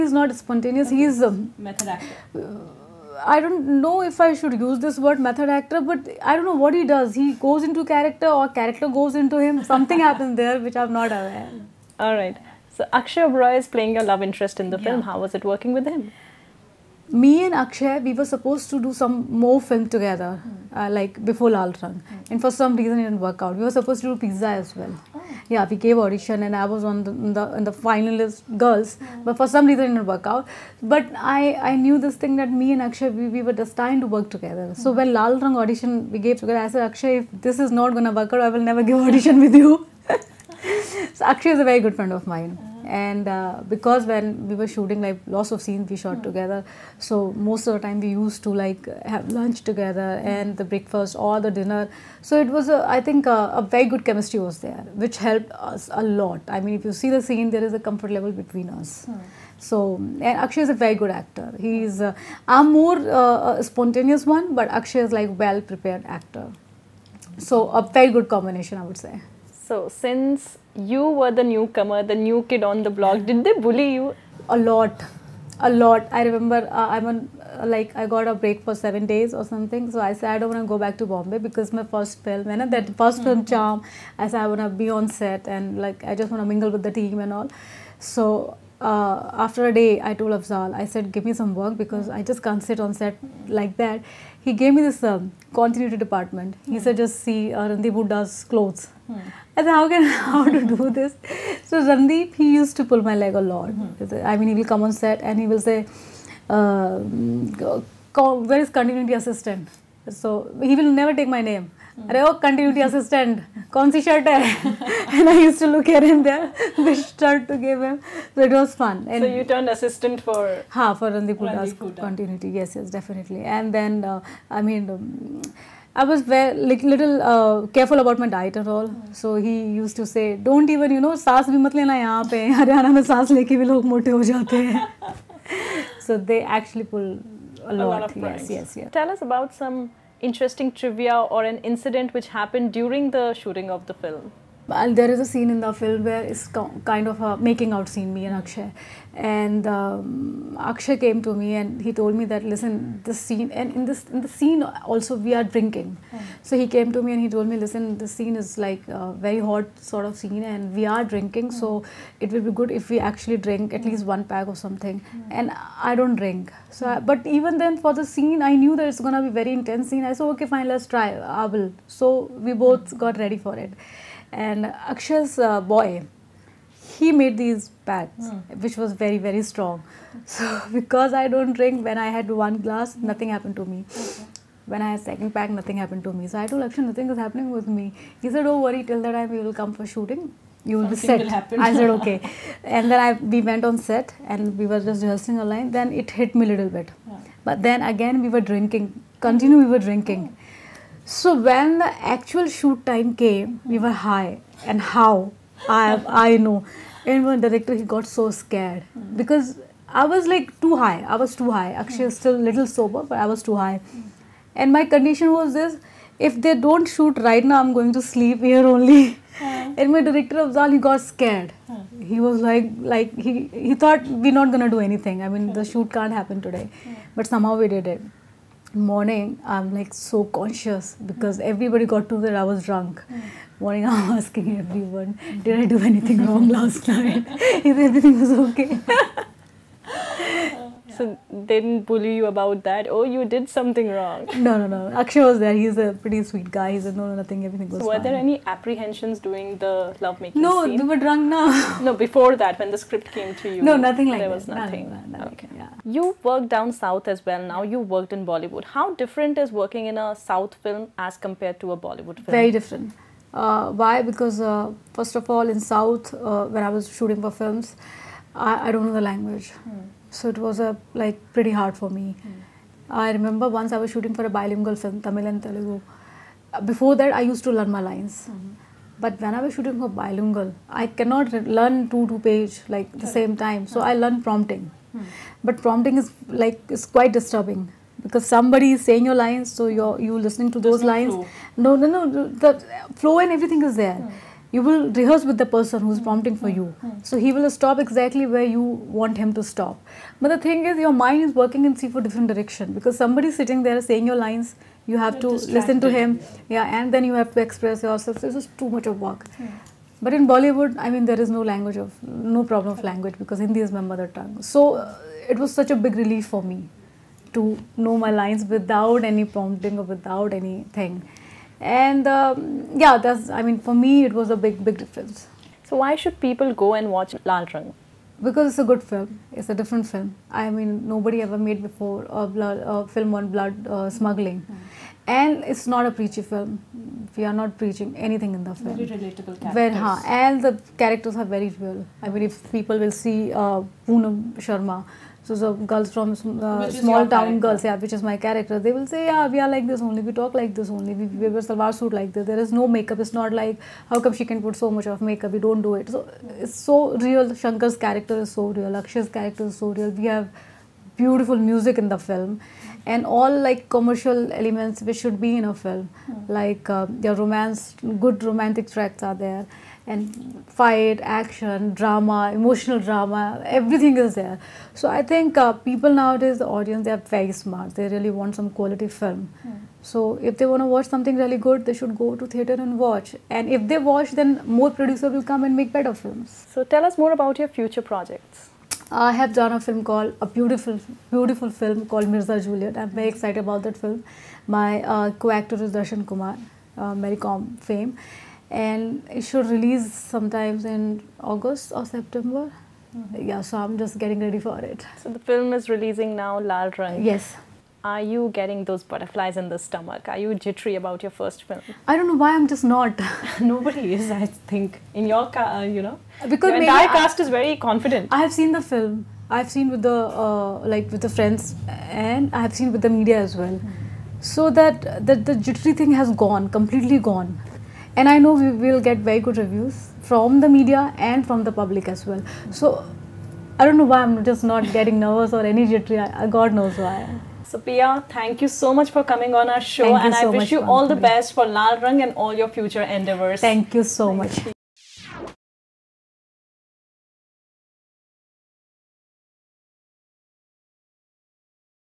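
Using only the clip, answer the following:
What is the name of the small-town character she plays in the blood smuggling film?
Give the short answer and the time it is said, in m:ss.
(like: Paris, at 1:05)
Poonam Sharma, at 5:43.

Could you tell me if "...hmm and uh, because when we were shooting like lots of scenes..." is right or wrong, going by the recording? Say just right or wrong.
right.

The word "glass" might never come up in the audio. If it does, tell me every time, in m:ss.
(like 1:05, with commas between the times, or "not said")
3:02.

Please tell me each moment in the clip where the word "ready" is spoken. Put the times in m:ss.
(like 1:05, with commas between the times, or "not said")
2:53, 6:44.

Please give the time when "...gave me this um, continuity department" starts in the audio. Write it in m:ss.
1:34.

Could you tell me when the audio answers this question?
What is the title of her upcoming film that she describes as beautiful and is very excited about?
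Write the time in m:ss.
6:32.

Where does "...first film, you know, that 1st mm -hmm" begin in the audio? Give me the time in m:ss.
1:21.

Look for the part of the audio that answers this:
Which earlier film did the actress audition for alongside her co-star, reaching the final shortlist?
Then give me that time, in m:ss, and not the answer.
0:24.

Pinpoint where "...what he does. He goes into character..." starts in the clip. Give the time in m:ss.
0:06.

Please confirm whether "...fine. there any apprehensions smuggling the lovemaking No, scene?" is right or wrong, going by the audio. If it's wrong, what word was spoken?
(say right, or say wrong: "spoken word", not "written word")
wrong: "during", not "smuggling".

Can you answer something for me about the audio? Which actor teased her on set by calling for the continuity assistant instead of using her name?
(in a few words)
Randeep Hooda.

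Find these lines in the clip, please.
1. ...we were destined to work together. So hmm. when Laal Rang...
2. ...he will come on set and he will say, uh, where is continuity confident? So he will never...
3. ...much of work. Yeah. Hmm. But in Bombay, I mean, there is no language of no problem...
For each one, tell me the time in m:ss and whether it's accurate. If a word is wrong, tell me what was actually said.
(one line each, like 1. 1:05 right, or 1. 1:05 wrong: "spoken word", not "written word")
1. 0:33 right
2. 1:44 wrong: "assistant", not "confident"
3. 5:08 wrong: "Bollywood", not "Bombay".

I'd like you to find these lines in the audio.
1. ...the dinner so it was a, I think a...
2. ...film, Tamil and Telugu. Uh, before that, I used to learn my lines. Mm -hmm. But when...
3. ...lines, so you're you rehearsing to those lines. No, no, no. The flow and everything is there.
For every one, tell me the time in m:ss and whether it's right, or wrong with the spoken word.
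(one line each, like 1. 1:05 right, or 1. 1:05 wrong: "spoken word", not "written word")
1. 0:51 right
2. 4:34 right
3. 4:49 wrong: "listening", not "rehearsing".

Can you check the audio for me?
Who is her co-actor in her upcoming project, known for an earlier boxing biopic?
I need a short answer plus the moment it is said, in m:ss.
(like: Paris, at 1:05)
Darshan Kumar, at 6:35.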